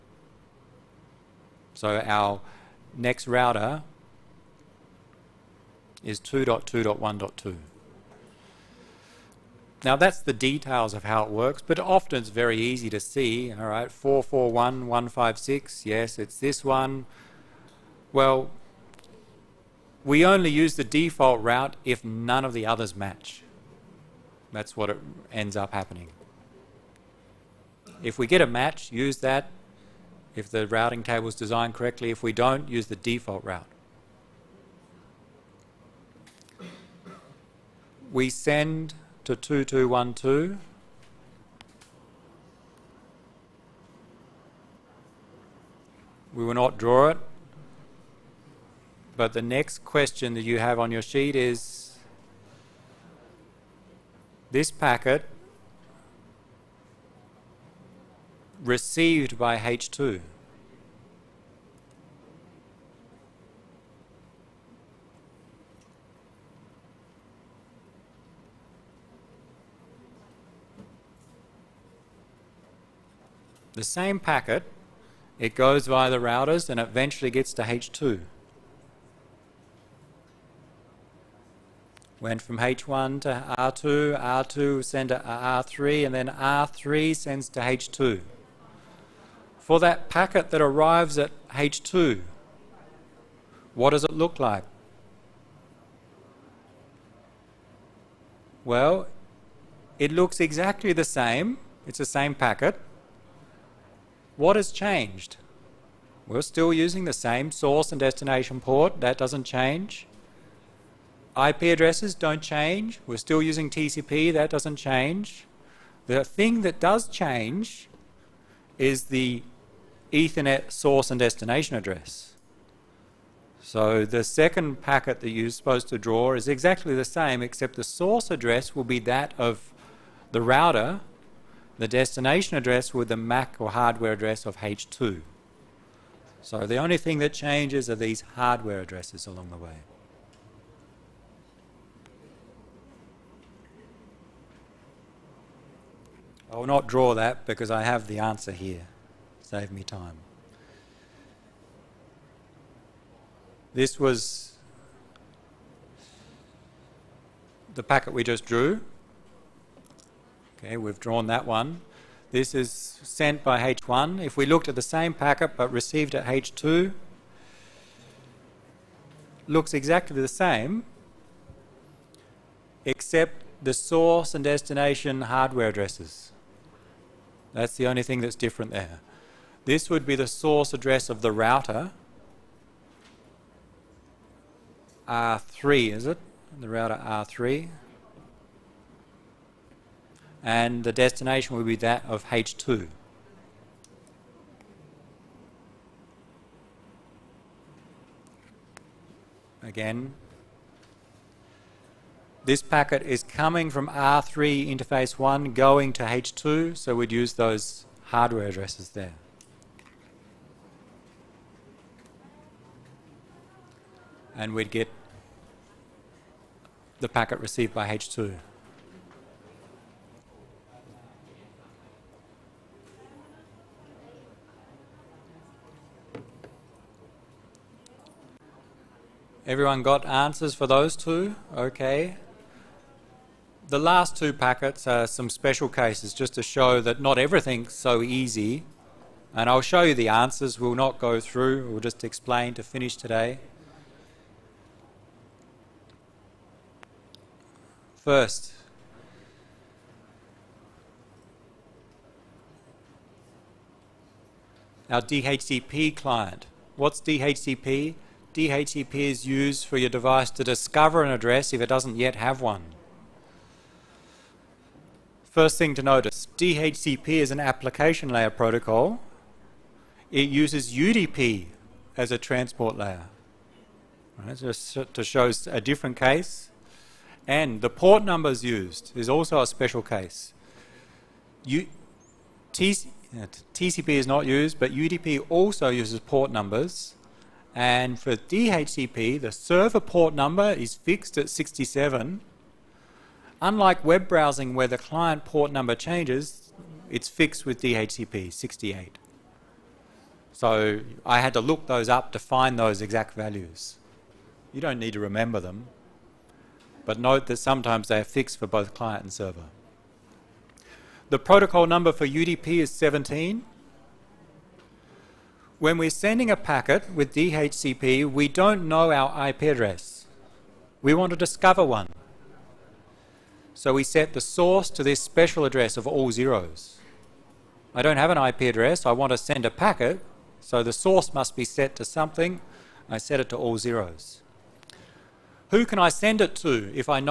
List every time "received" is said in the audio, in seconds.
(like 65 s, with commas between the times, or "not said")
58 s, 165 s, 217 s.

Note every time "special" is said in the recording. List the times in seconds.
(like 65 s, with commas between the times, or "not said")
235 s, 279 s, 324 s.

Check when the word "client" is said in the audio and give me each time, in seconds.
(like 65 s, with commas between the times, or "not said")
255 s, 294 s, 308 s.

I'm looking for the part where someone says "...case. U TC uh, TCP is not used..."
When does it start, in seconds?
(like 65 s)
279 s.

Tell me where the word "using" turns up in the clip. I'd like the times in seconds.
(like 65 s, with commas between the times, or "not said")
106 s, 113 s.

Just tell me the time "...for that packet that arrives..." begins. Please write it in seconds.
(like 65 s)
89 s.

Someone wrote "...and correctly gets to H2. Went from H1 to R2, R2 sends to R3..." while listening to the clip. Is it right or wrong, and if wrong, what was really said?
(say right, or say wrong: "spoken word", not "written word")
wrong: "eventually", not "correctly".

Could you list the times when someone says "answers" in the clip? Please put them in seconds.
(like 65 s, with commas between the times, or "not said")
148 s, 230 s, 240 s.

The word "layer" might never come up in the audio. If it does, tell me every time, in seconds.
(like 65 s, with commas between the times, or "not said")
268 s, 272 s.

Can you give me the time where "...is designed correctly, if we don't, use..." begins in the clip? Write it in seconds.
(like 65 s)
31 s.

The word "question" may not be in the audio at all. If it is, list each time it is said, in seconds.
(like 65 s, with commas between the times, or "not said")
49 s.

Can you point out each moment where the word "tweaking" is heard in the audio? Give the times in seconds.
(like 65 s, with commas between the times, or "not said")
not said.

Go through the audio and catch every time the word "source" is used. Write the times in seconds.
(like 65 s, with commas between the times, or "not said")
107 s, 120 s, 127 s, 173 s, 180 s, 324 s, 330 s.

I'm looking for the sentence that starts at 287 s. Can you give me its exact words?
And for DHCP, the server port number is fixed at 67.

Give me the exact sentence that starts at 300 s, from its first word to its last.
So I had to look those up to find those exact values.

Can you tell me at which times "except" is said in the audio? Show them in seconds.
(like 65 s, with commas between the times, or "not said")
127 s, 172 s.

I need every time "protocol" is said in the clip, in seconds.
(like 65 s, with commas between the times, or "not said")
268 s, 311 s.